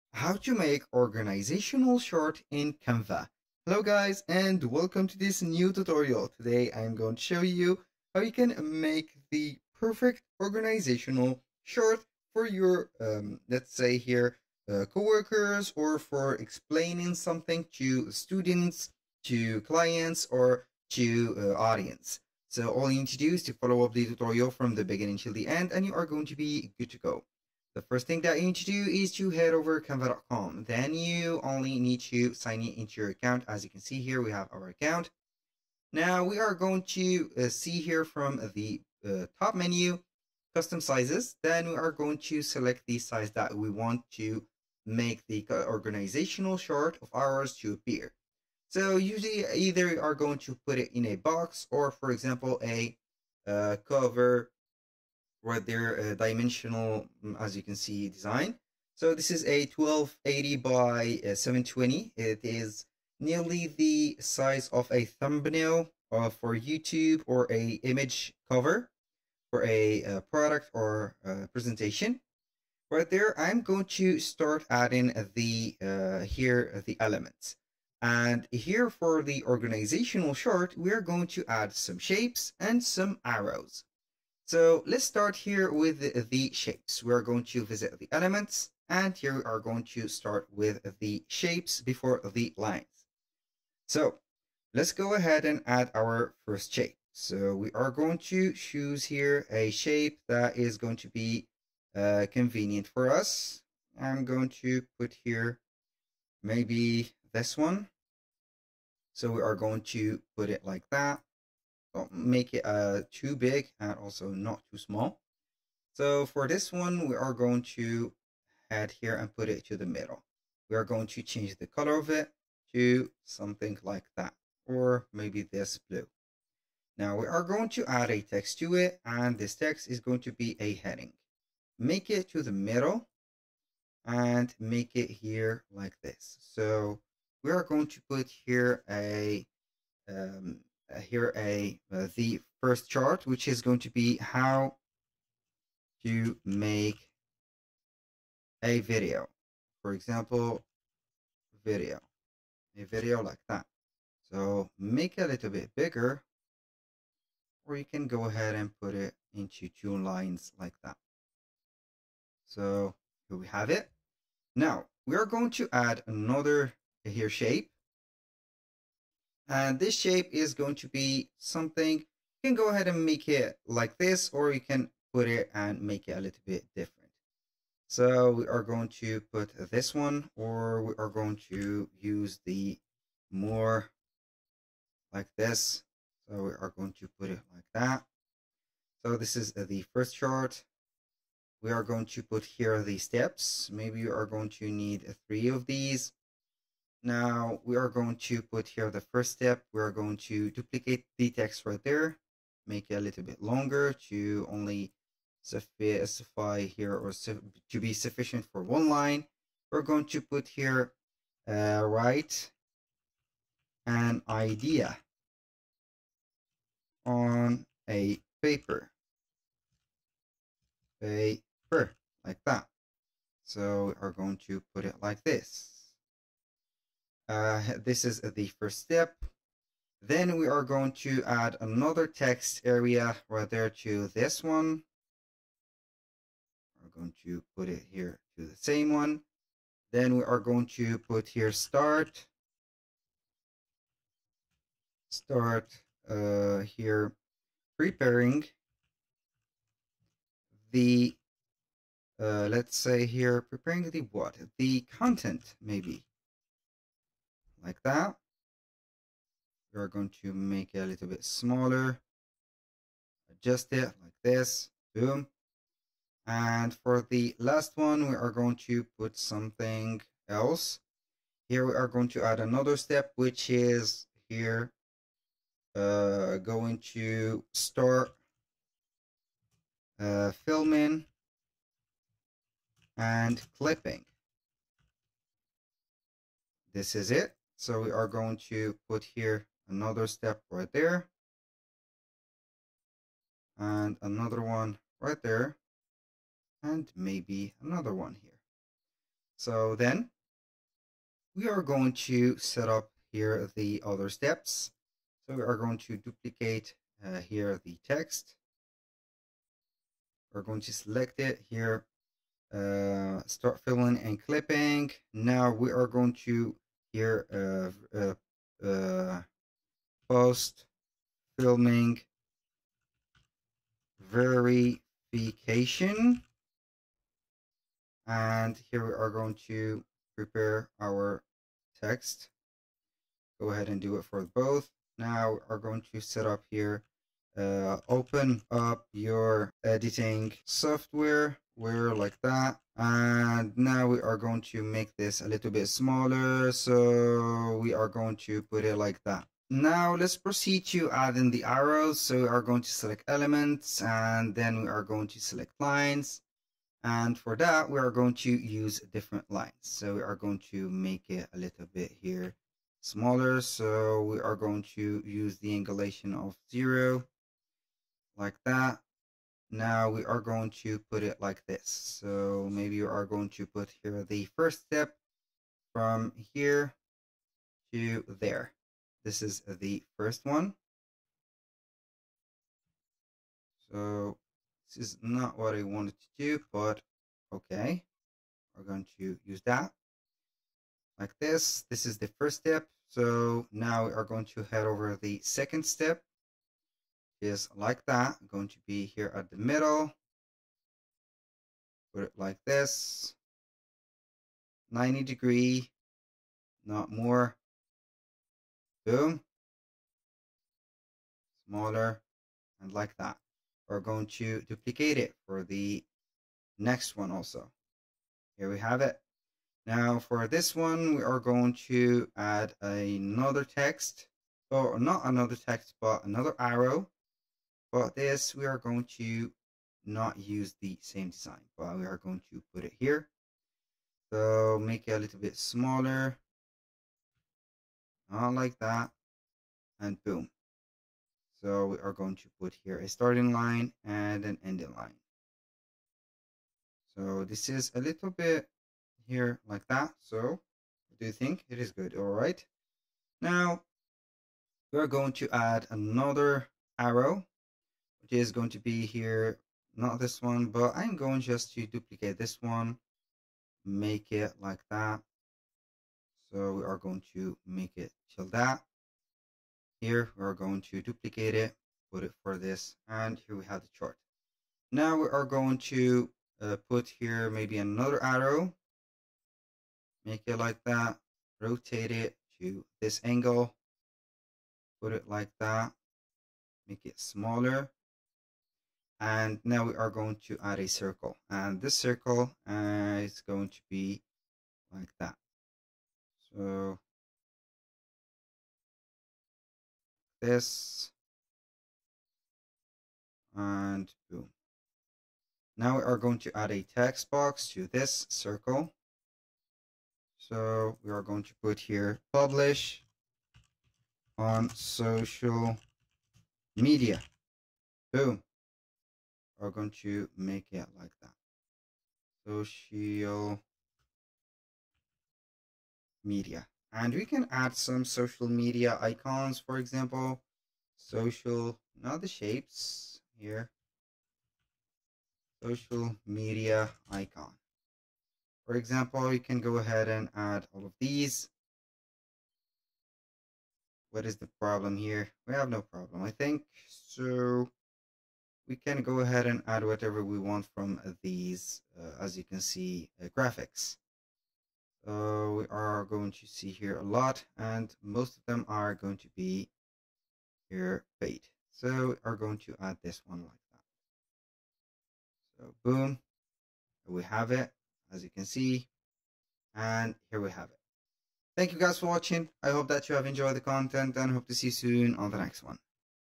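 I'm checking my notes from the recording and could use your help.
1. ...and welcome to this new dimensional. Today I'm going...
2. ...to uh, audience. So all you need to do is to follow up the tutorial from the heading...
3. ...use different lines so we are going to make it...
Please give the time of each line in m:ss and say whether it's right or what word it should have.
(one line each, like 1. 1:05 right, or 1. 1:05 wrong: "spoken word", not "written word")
1. 0:04 wrong: "tutorial", not "dimensional"
2. 0:20 wrong: "beginning", not "heading"
3. 5:58 right.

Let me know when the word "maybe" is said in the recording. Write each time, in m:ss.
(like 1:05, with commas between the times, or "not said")
1:46, 2:05, 3:13, 4:15, 4:56, 6:12, 7:57.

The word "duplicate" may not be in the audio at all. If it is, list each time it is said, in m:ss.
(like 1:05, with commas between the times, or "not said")
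3:20, 5:05, 6:54, 7:41, 7:50.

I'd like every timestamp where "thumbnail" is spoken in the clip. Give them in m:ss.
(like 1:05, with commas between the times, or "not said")
1:05.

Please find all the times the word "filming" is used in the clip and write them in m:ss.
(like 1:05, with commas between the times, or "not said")
4:40, 5:21.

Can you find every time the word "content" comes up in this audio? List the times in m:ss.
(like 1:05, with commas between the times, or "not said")
4:14, 9:33.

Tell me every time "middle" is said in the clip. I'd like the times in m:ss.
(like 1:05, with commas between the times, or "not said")
1:59, 2:12, 6:39.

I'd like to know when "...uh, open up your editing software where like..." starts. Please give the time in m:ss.
5:37.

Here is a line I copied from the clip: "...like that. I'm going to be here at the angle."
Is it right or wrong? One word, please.
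wrong.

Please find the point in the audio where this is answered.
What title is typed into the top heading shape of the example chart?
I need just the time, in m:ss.
2:24.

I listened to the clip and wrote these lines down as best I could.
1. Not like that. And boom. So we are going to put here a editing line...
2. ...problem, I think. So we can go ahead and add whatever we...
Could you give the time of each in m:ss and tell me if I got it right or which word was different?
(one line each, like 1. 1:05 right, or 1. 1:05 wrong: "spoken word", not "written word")
1. 7:18 wrong: "starting", not "editing"
2. 9:05 right.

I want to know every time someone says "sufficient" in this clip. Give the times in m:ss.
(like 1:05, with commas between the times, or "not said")
3:27.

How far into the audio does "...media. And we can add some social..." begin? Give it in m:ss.
8:46.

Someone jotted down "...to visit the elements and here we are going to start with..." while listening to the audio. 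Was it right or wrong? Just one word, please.
right.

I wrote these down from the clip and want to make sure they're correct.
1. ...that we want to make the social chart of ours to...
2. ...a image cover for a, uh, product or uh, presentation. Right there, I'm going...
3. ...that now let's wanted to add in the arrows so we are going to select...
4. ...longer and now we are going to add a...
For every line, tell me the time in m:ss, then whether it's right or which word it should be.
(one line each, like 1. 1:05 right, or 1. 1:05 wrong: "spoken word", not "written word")
1. 0:43 wrong: "organizational", not "social"
2. 1:07 right
3. 5:49 wrong: "proceed", not "wanted"
4. 8:06 wrong: "smaller", not "longer".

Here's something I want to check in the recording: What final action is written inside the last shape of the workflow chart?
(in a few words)
Publish on social media.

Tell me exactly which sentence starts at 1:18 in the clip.
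And here for the organizational chart, we are going to add some shapes and some arrows.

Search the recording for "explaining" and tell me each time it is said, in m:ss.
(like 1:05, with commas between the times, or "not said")
0:16.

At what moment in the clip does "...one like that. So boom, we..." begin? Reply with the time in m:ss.
9:23.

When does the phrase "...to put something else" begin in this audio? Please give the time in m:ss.
4:28.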